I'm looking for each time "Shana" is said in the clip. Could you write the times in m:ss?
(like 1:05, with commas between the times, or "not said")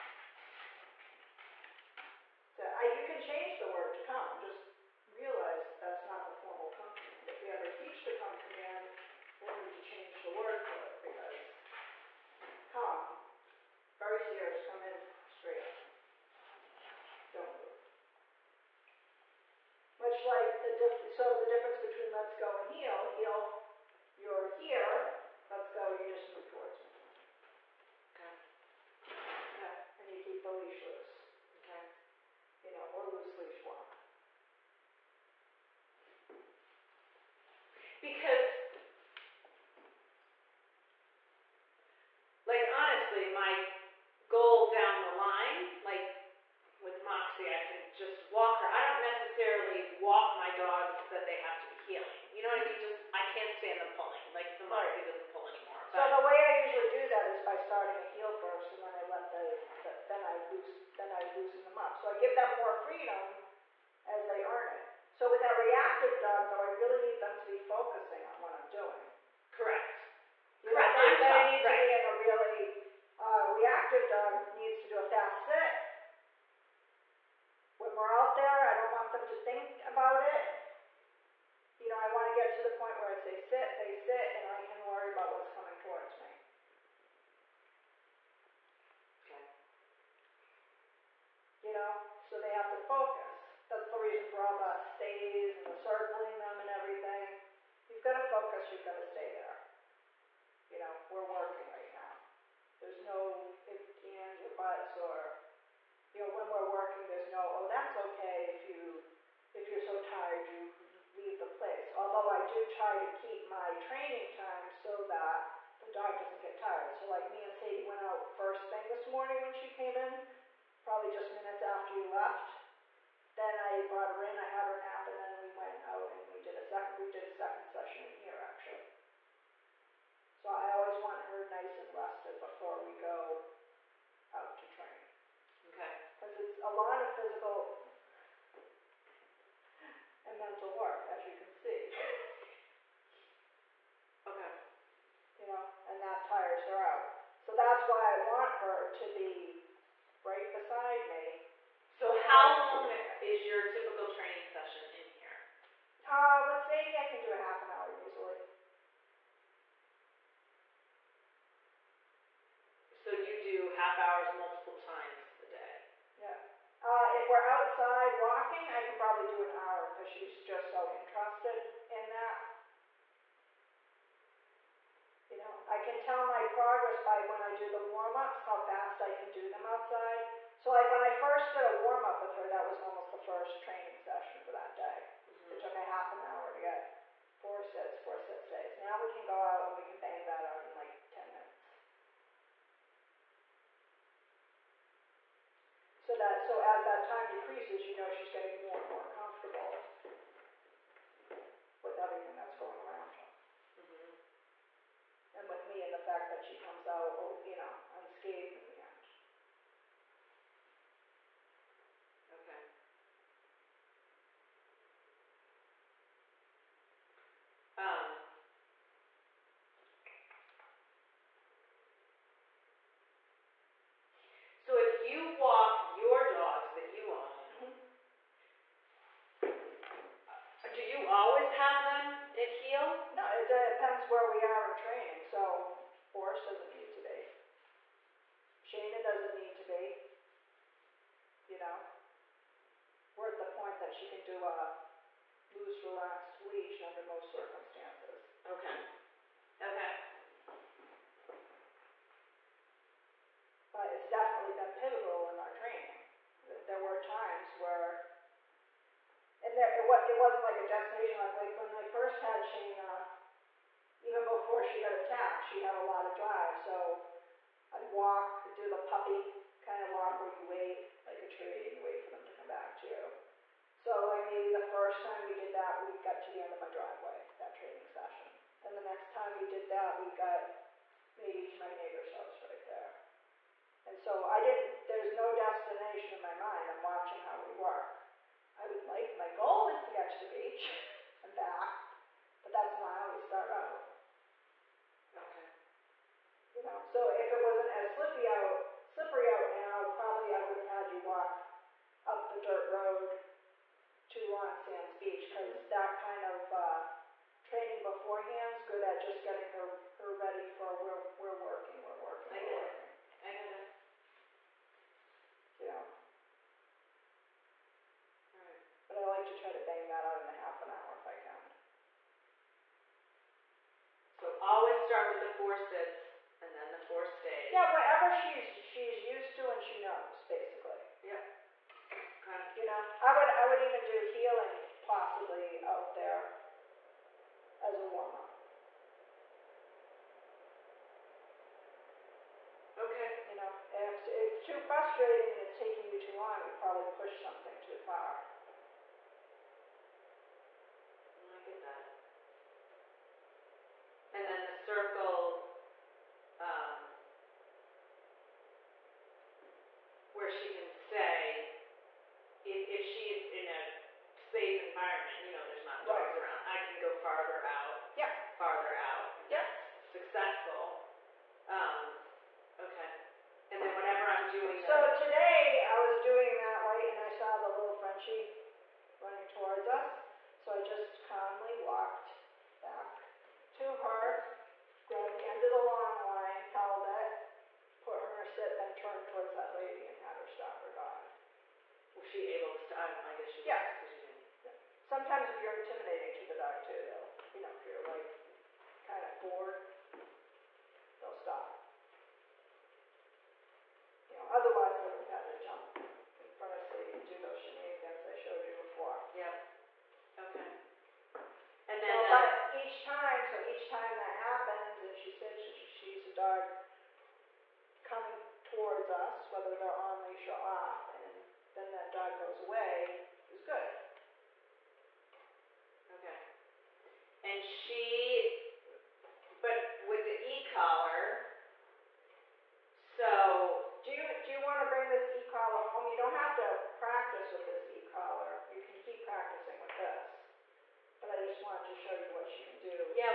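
3:58, 4:22.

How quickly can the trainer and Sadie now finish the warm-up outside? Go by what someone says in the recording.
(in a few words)
10 minutes.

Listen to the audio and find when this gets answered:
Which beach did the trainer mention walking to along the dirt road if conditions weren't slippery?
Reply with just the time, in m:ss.
5:04.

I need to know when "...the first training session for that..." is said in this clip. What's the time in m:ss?
3:03.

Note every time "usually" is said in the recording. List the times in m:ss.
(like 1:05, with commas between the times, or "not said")
0:56, 2:38.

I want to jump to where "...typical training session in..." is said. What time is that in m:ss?
2:33.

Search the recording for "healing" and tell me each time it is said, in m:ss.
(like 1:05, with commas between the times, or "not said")
0:51, 5:34.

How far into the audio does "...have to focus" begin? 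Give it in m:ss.
1:32.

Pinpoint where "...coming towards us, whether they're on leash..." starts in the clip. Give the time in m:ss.
6:57.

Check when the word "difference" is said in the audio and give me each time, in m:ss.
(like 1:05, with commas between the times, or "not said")
0:21.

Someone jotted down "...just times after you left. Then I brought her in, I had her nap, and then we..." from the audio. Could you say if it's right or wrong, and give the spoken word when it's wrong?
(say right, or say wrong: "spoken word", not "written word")
wrong: "minutes", not "times".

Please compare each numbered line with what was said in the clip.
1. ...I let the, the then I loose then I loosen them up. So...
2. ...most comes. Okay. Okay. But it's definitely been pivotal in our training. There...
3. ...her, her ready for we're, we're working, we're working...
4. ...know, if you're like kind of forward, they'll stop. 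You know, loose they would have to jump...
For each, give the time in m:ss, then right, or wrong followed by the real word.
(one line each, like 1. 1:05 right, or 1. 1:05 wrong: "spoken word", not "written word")
1. 0:58 right
2. 4:07 wrong: "circumstances", not "comes"
3. 5:09 right
4. 6:37 wrong: "otherwise", not "loose".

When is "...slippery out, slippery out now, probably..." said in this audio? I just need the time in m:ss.
4:57.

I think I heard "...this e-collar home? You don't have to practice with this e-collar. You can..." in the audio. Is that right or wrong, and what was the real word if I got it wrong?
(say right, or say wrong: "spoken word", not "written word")
right.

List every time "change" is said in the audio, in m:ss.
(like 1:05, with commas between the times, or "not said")
0:09.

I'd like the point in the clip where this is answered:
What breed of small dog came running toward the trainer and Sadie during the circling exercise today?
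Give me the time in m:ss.
6:17.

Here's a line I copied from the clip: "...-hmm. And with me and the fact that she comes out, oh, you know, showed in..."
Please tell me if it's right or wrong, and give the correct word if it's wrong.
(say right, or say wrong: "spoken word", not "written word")
wrong: "unscathed", not "showed".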